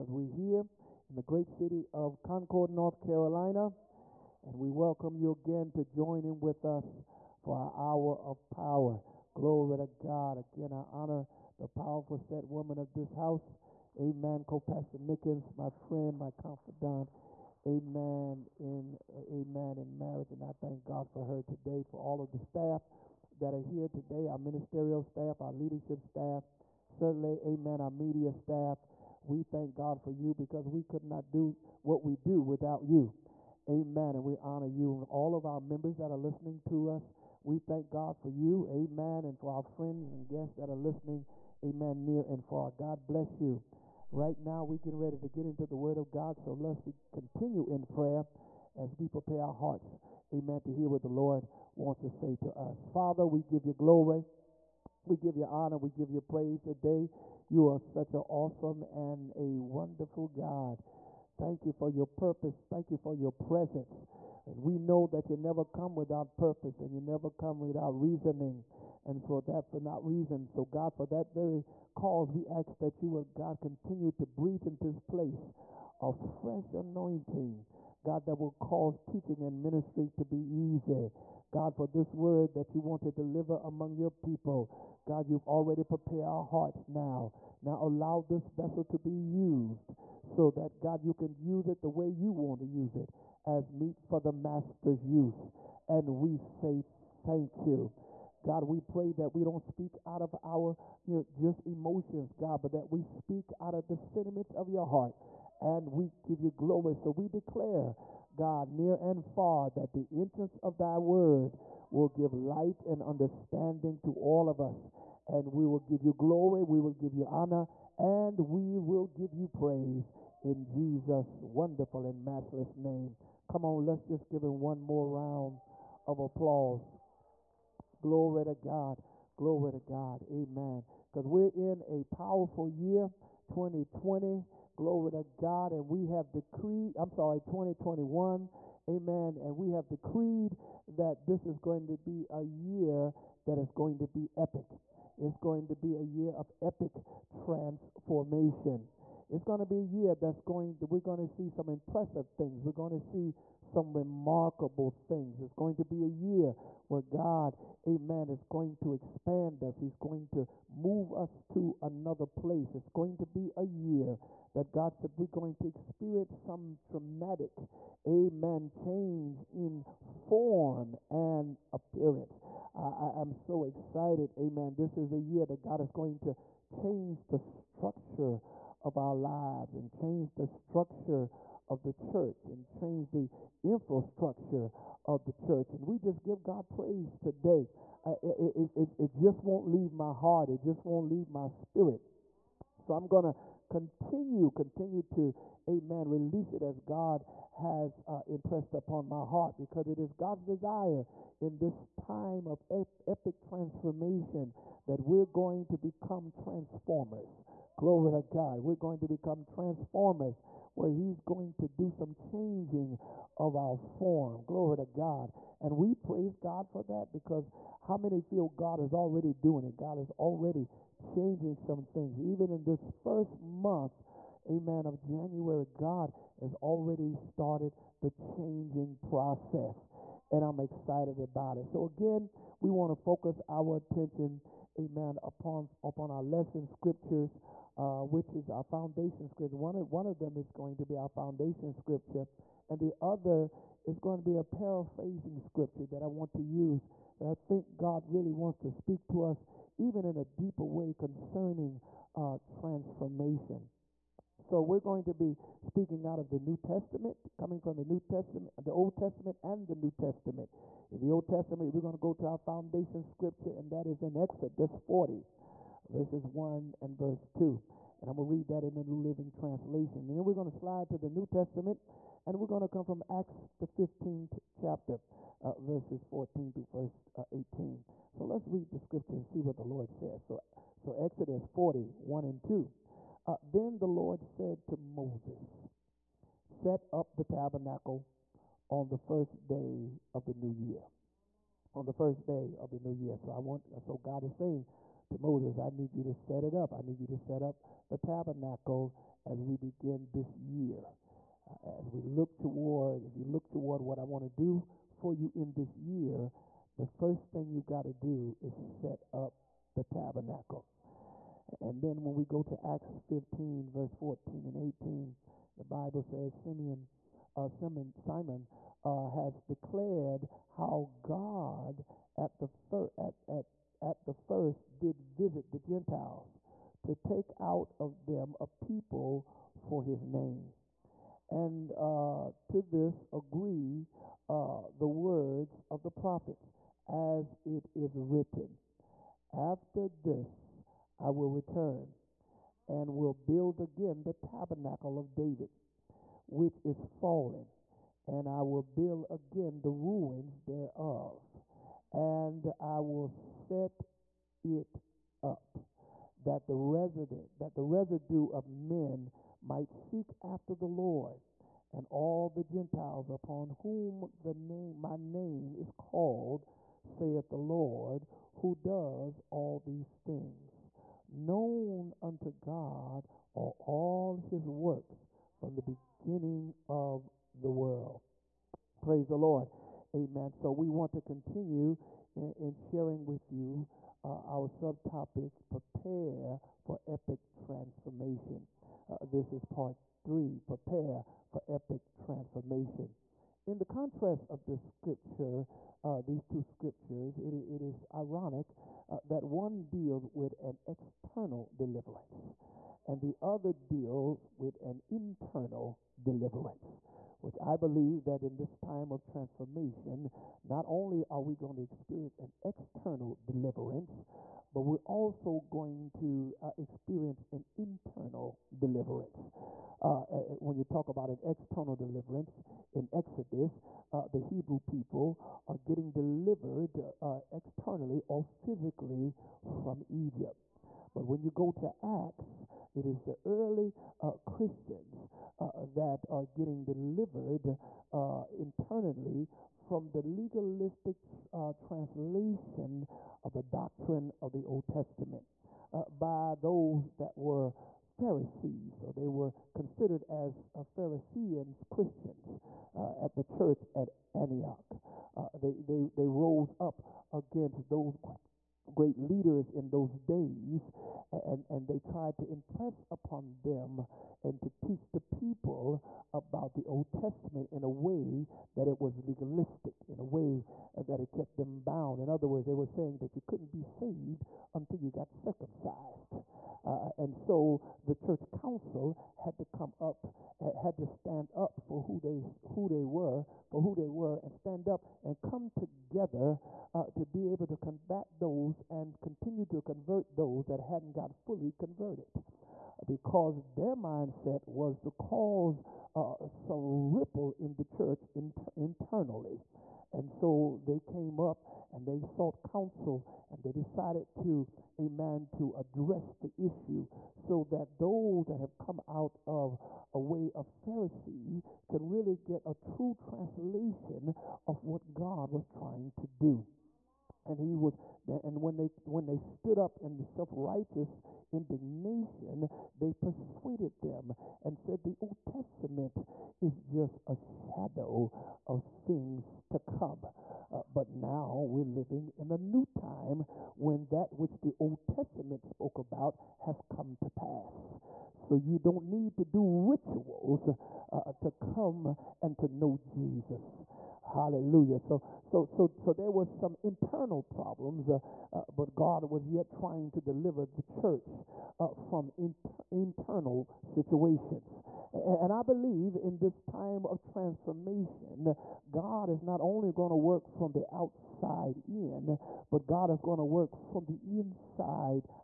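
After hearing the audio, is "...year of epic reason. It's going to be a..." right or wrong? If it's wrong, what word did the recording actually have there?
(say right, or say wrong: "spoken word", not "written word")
wrong: "transformation", not "reason".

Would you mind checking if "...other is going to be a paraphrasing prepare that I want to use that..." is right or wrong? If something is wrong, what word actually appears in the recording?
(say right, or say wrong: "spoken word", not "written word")
wrong: "scripture", not "prepare".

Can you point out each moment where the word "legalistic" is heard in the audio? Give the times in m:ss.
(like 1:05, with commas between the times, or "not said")
7:20, 7:49.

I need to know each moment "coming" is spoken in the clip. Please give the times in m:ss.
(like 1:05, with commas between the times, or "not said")
4:17.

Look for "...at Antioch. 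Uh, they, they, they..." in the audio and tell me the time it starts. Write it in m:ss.
7:33.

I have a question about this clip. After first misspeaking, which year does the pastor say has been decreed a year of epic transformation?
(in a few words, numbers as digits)
2021.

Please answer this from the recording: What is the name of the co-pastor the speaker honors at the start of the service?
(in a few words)
Mickens.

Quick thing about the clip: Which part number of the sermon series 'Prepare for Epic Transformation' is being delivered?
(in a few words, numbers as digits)
3.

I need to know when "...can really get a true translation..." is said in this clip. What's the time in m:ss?
8:31.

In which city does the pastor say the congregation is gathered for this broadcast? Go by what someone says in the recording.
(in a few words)
Concord, North Carolina.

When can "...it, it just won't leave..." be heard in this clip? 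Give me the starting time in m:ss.
3:08.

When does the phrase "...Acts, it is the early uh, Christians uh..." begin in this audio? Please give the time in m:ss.
7:11.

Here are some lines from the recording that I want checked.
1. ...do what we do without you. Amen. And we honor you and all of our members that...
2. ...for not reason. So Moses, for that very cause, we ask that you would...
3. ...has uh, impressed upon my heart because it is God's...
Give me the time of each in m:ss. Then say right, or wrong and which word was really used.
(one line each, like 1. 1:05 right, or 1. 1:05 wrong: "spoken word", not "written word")
1. 0:31 right
2. 1:09 wrong: "God", not "Moses"
3. 3:17 right.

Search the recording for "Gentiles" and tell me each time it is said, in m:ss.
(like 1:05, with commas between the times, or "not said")
5:25, 6:02.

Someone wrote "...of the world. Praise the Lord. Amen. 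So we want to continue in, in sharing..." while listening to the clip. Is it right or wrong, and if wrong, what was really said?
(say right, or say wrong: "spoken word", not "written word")
right.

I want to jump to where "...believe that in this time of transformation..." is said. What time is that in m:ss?
6:47.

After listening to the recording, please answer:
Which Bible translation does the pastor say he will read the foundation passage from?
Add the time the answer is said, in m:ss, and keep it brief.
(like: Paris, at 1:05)
New Living Translation, at 4:28.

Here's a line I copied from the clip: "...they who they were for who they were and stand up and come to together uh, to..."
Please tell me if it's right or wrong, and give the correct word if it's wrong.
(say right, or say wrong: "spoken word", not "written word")
right.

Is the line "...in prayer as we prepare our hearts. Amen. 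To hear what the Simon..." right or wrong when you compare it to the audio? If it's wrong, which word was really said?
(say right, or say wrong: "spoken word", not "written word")
wrong: "Lord", not "Simon".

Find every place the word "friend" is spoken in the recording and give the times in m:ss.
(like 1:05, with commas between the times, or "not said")
0:15, 0:39.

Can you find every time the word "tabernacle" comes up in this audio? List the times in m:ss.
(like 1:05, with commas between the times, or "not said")
4:47, 4:57, 5:09, 5:44.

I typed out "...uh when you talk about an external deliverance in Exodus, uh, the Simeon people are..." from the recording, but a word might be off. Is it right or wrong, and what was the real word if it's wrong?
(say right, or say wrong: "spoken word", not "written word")
wrong: "Hebrew", not "Simeon".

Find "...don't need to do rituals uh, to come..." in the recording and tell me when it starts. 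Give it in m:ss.
8:58.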